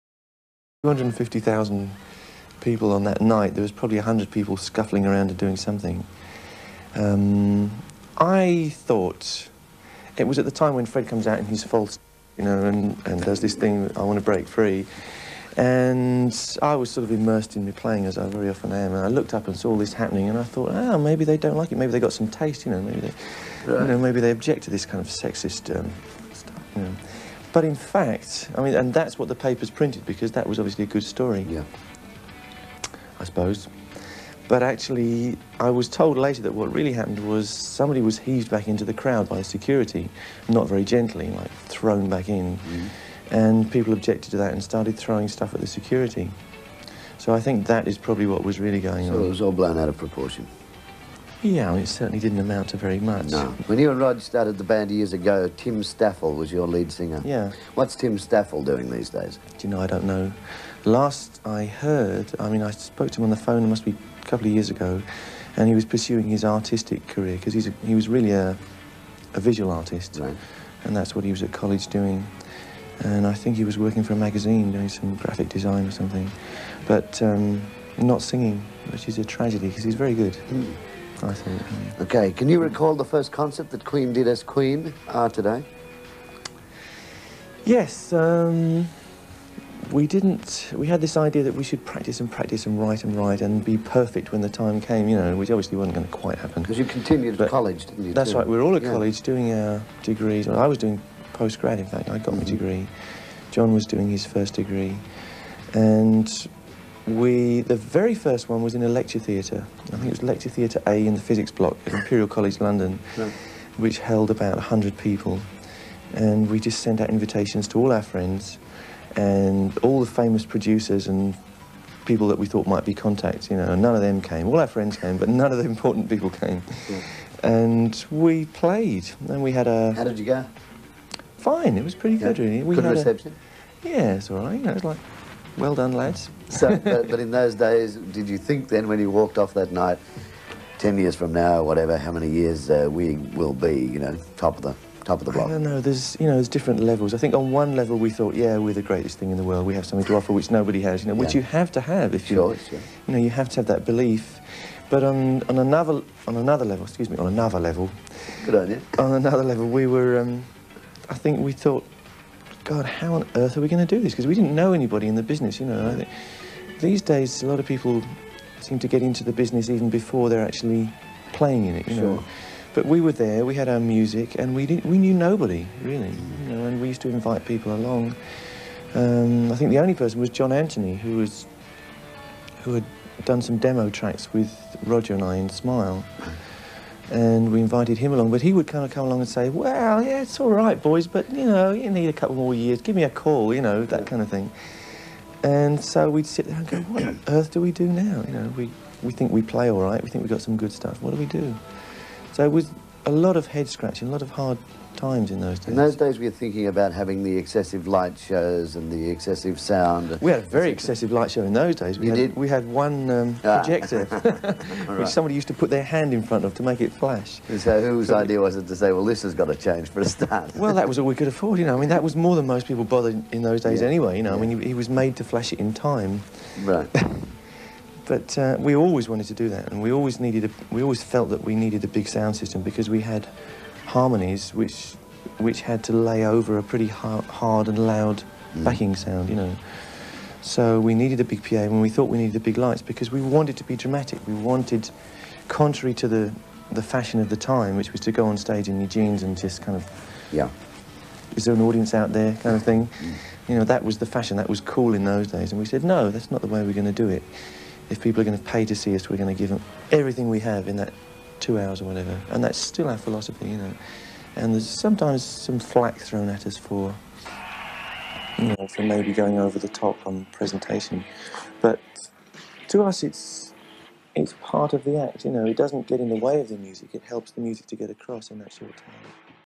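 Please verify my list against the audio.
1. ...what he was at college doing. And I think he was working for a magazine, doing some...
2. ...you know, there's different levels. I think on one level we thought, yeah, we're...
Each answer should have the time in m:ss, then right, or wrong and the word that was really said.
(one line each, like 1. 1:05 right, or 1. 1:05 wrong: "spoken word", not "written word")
1. 1:11 right
2. 2:26 right.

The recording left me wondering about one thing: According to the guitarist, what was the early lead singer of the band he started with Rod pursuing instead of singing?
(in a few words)
artistic career.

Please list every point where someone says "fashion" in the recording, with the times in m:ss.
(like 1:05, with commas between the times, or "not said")
4:06, 4:14.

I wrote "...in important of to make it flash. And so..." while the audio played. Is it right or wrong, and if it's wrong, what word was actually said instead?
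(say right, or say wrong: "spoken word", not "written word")
wrong: "front", not "important".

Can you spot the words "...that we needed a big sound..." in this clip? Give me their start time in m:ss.
3:51.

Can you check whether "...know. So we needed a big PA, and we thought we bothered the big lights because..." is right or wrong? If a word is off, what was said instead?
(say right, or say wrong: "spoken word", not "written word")
wrong: "needed", not "bothered".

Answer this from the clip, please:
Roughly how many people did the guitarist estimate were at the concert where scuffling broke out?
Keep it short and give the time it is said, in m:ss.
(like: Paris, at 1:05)
250,000, at 0:00.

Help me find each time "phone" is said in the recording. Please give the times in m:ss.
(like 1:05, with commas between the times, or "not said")
1:03.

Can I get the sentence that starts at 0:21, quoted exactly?
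Maybe they got some taste, you know.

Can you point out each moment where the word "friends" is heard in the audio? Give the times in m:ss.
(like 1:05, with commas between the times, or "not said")
1:58, 2:04.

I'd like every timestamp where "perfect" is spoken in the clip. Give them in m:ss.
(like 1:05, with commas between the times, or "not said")
1:33.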